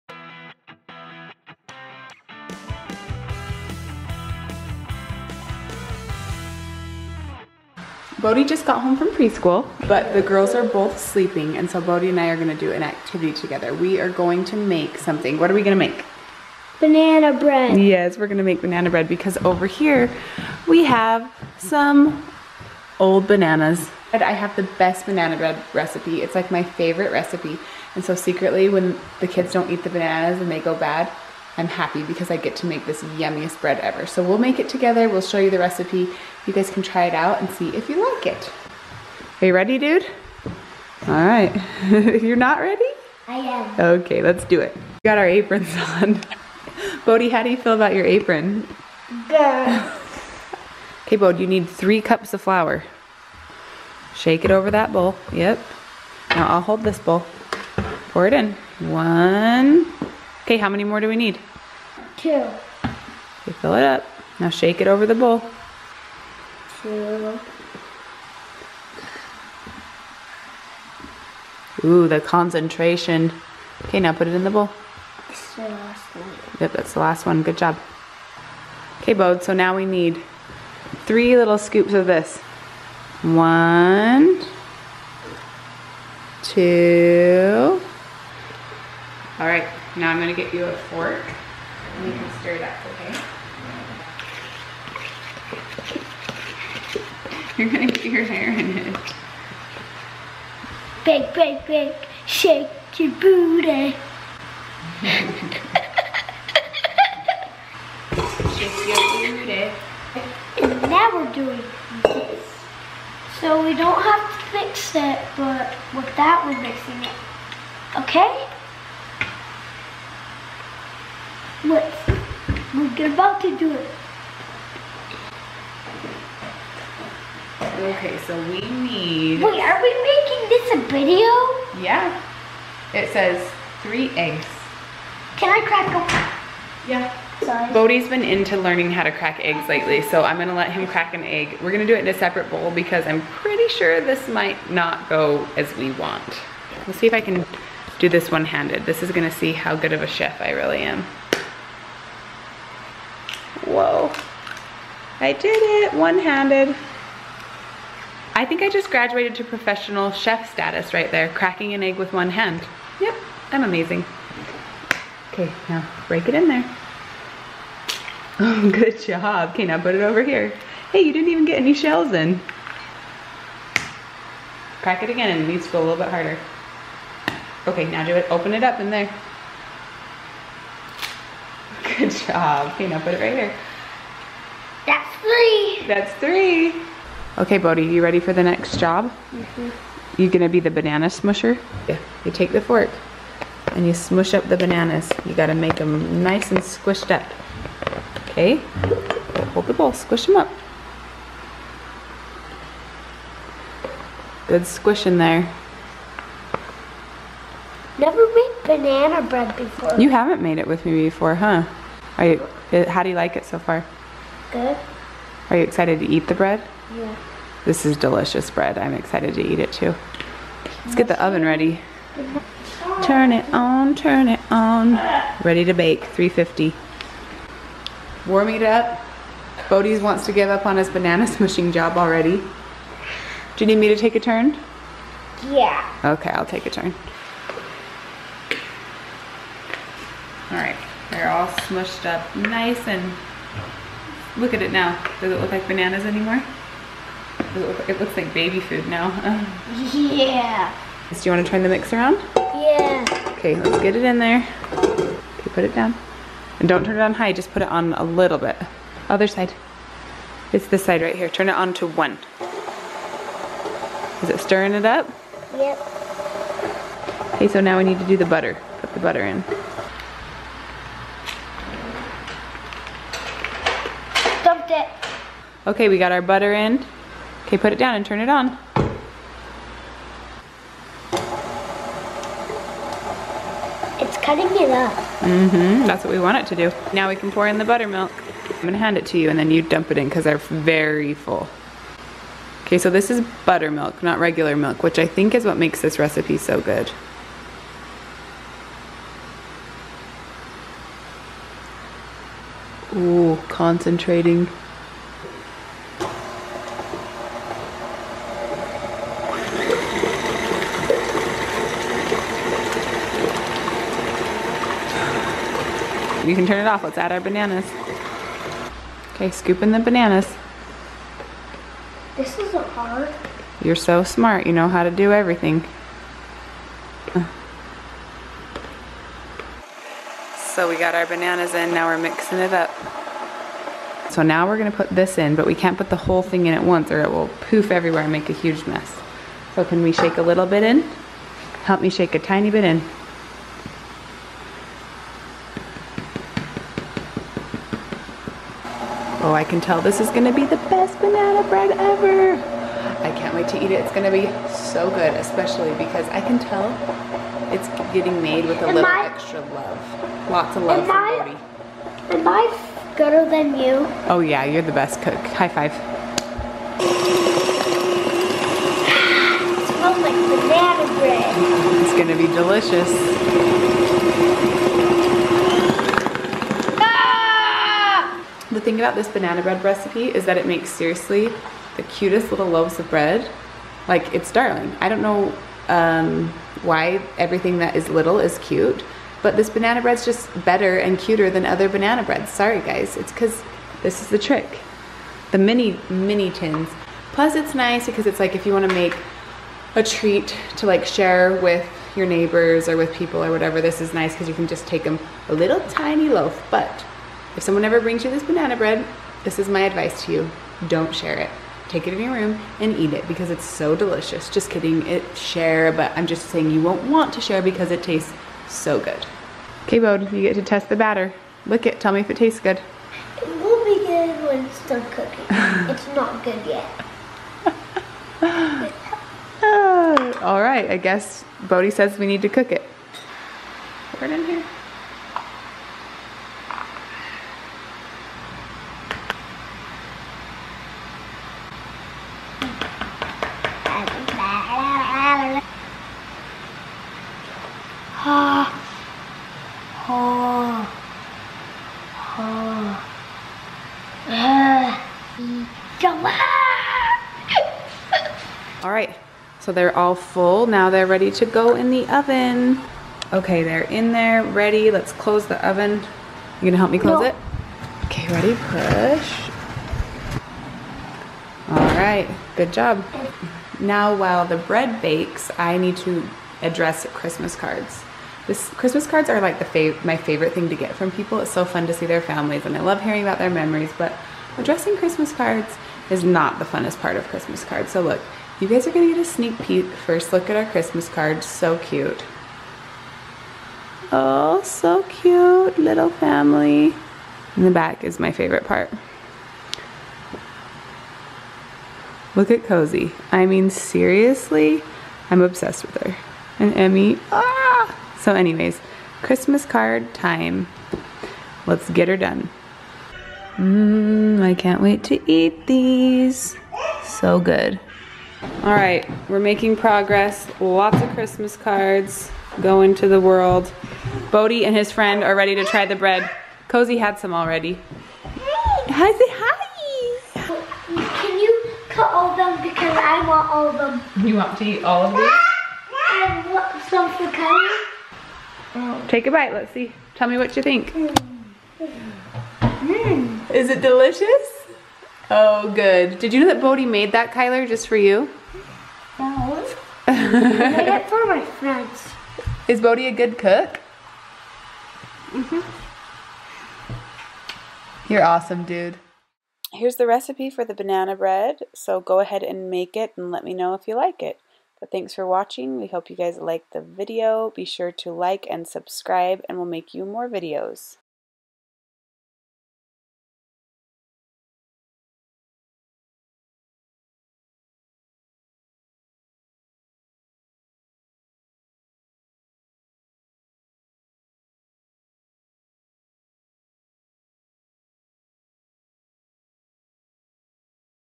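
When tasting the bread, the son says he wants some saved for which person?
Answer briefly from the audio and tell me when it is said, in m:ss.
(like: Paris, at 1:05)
Kylie, at 8:57.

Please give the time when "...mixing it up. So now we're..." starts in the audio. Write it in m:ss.
5:31.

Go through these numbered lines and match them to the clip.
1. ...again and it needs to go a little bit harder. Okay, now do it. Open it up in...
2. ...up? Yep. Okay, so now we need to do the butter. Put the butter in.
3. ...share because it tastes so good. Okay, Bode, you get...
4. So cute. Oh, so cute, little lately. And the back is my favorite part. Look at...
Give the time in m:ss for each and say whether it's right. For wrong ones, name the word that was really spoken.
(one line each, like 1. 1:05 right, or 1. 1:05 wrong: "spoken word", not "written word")
1. 2:55 right
2. 4:24 right
3. 6:57 right
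4. 8:11 wrong: "family", not "lately".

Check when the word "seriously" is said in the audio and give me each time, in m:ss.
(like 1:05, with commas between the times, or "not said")
6:20, 8:23.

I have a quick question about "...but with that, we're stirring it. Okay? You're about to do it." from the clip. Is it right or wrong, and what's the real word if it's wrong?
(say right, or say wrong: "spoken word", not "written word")
wrong: "mixing", not "stirring".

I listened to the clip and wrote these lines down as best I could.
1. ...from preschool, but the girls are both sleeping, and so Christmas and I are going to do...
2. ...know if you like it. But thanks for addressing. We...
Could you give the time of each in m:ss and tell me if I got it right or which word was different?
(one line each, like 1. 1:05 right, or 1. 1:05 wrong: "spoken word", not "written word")
1. 0:08 wrong: "Bode", not "Christmas"
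2. 9:23 wrong: "watching", not "addressing".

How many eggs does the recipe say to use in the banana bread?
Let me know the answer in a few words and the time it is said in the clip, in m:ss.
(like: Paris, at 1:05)
3, at 2:13.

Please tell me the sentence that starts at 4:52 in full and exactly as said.
Okay, so this is buttermilk, not regular milk, which I think is what makes this recipe so good.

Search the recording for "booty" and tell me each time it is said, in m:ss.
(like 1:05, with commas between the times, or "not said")
1:43, 1:49.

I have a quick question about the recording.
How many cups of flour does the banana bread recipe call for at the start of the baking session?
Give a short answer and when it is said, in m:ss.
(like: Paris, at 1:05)
3, at 0:51.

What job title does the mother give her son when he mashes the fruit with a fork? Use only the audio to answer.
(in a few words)
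banana smusher.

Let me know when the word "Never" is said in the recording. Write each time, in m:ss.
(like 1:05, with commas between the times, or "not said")
3:27.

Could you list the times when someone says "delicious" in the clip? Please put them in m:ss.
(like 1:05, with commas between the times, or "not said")
3:37, 6:12, 6:53, 9:03.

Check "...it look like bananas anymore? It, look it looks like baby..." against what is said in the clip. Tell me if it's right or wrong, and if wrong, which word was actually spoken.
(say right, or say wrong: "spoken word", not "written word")
right.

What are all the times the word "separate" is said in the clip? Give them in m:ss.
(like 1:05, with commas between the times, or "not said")
2:22.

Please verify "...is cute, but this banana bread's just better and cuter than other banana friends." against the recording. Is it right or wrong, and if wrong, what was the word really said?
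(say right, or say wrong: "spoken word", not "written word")
wrong: "breads", not "friends".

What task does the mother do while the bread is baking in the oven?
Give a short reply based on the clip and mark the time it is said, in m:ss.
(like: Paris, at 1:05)
address Christmas cards, at 7:56.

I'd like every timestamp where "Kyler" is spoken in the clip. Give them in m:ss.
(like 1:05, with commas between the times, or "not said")
9:07.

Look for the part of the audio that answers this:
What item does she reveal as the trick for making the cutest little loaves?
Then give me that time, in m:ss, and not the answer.
6:35.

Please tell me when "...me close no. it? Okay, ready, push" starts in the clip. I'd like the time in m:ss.
7:46.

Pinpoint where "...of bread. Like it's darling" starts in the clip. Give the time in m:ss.
6:22.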